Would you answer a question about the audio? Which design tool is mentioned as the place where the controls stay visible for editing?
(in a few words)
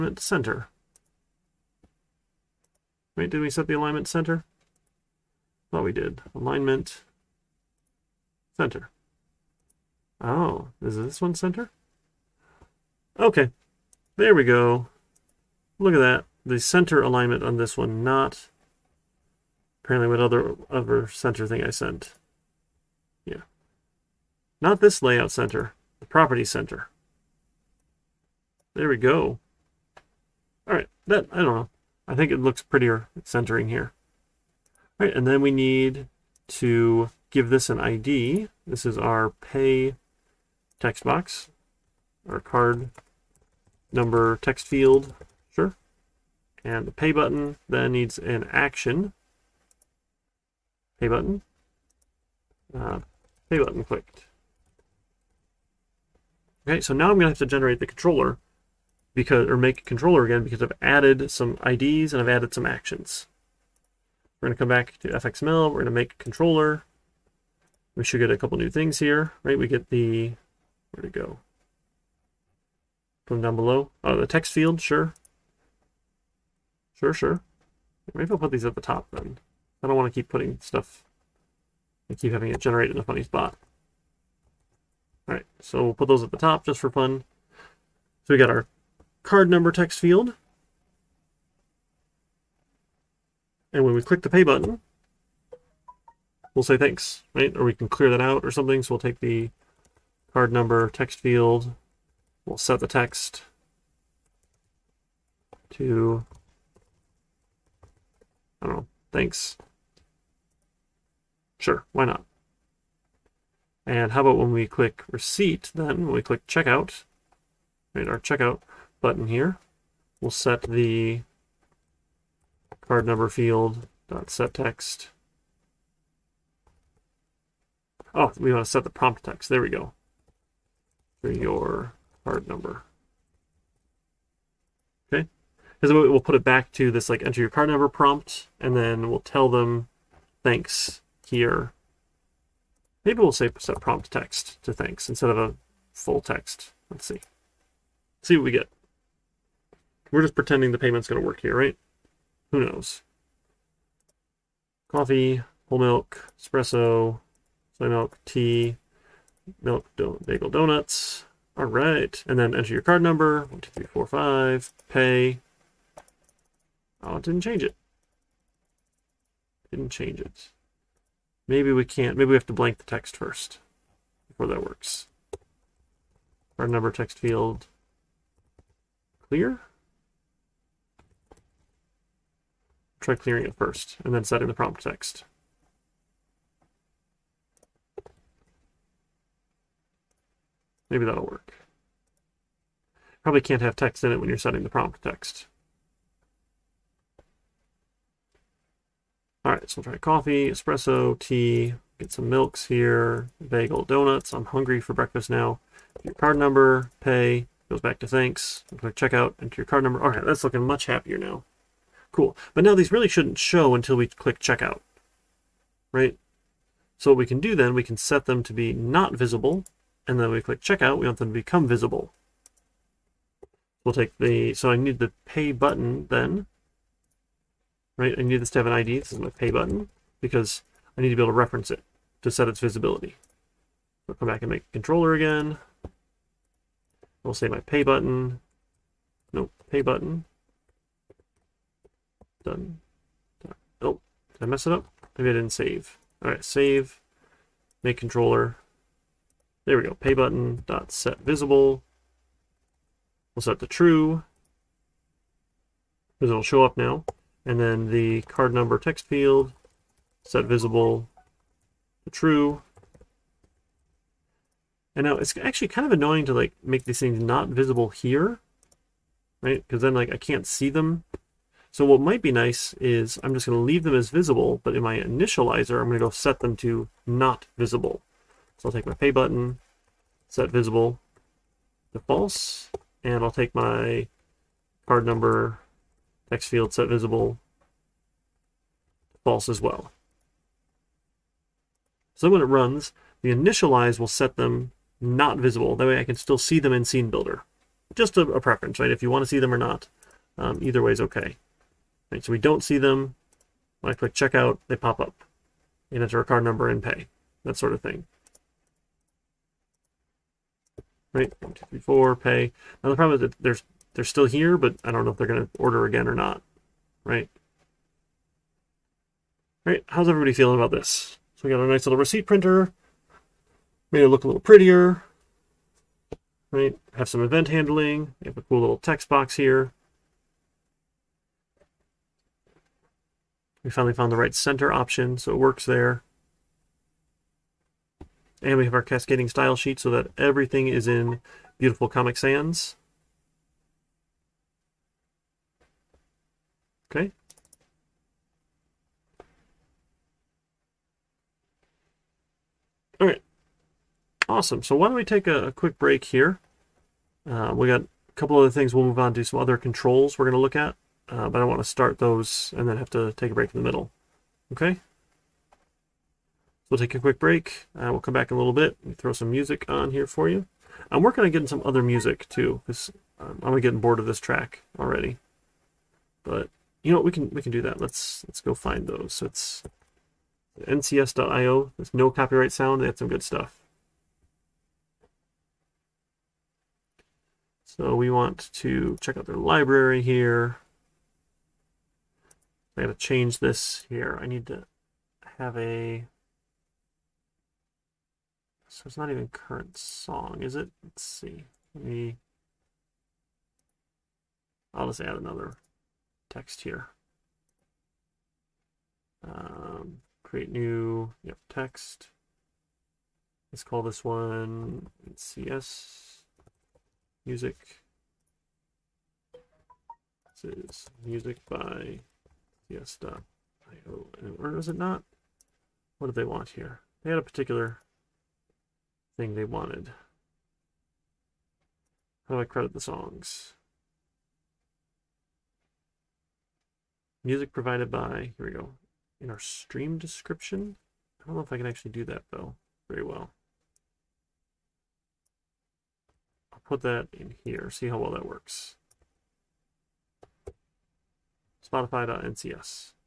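Scene Builder.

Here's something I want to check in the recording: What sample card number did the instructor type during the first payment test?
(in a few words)
12345.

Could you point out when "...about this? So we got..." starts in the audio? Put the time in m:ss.
5:20.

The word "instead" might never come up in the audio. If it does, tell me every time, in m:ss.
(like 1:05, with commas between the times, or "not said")
2:25.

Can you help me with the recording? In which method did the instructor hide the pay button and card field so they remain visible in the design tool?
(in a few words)
initialize.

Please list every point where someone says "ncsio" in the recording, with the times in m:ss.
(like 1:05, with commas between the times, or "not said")
6:20, 7:02.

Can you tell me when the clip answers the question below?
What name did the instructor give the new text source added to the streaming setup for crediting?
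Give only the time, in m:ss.
6:55.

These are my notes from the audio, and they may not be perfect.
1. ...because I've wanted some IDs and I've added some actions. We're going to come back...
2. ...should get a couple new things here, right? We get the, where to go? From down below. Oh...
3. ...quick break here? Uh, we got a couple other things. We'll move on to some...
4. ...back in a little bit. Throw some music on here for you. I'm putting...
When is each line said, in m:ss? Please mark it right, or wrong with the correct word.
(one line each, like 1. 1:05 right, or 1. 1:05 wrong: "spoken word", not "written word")
1. 1:00 wrong: "added", not "wanted"
2. 1:08 right
3. 5:55 right
4. 6:08 wrong: "working", not "putting".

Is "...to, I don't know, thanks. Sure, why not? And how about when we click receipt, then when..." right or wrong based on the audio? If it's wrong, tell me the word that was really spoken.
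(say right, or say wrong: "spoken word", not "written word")
right.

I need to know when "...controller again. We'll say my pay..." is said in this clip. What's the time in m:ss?
3:54.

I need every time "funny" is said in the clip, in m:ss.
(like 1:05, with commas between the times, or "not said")
1:23.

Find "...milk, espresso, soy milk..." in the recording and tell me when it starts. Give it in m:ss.
2:35.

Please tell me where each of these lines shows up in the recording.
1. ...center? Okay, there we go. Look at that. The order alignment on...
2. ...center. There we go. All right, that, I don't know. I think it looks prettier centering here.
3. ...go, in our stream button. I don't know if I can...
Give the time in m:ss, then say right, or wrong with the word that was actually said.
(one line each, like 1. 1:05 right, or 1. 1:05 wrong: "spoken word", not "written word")
1. 0:11 wrong: "center", not "order"
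2. 0:26 right
3. 7:18 wrong: "description", not "button".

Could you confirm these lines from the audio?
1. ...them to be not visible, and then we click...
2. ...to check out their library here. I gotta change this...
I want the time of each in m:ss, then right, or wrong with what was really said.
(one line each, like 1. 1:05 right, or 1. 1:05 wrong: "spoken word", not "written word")
1. 3:38 right
2. 6:28 right.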